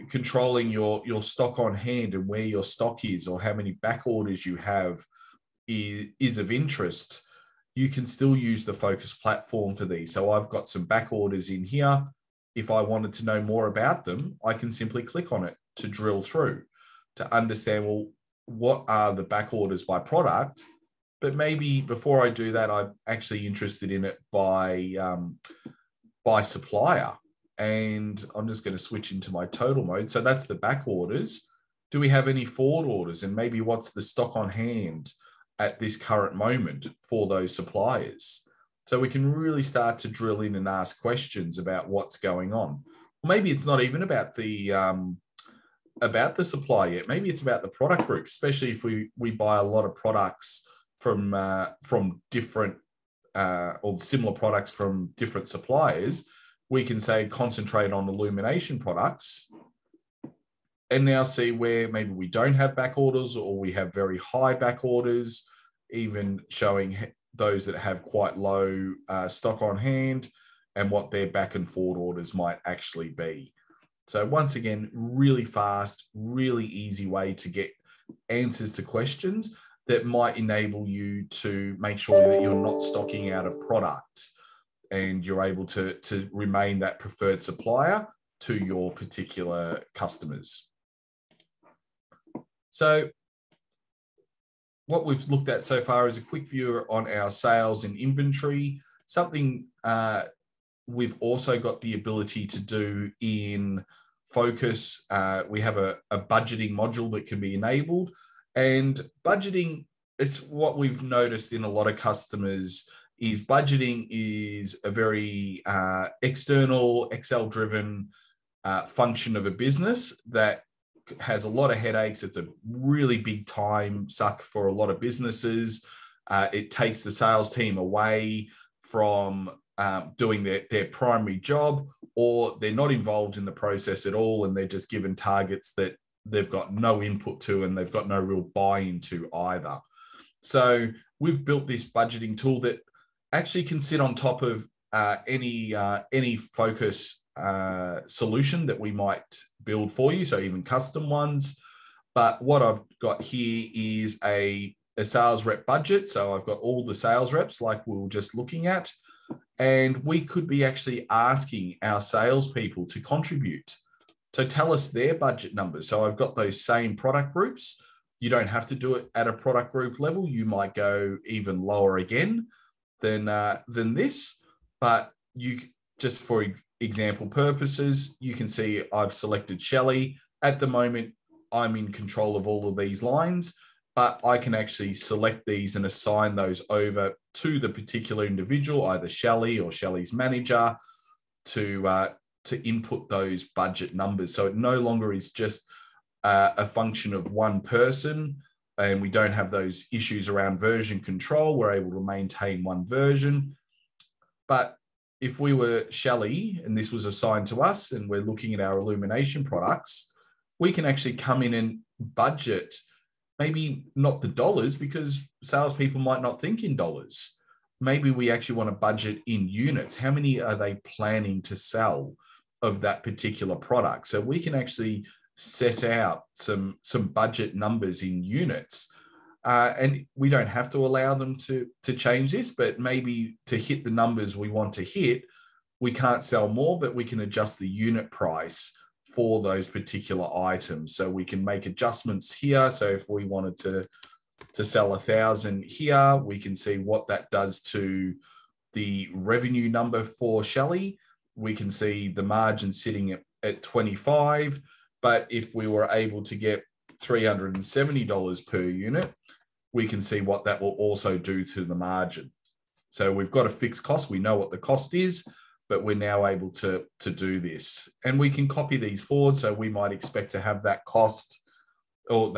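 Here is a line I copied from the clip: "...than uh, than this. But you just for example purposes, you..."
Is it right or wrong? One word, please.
right.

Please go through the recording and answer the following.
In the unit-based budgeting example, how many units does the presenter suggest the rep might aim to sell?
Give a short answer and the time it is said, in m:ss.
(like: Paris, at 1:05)
1000, at 4:04.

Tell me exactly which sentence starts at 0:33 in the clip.
And maybe what's the stock on hand at this current moment for those suppliers?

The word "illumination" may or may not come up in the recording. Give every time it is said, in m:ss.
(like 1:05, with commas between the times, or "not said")
0:58, 3:28.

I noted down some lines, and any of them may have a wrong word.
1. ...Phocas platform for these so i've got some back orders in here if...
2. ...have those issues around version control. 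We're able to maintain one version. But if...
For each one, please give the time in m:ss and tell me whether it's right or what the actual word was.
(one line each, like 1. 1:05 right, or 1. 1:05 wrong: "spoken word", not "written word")
1. 0:08 right
2. 3:19 right.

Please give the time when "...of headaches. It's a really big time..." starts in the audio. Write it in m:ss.
2:01.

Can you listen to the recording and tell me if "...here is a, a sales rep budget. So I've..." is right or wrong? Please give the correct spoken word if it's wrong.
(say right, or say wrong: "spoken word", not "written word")
right.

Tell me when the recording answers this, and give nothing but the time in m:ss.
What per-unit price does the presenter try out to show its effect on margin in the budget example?
4:17.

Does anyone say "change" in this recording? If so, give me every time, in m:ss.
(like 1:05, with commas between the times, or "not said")
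3:51.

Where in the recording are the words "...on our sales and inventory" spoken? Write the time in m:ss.
1:36.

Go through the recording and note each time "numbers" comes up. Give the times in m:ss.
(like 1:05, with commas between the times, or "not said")
2:45, 3:13, 3:47, 3:53, 4:09.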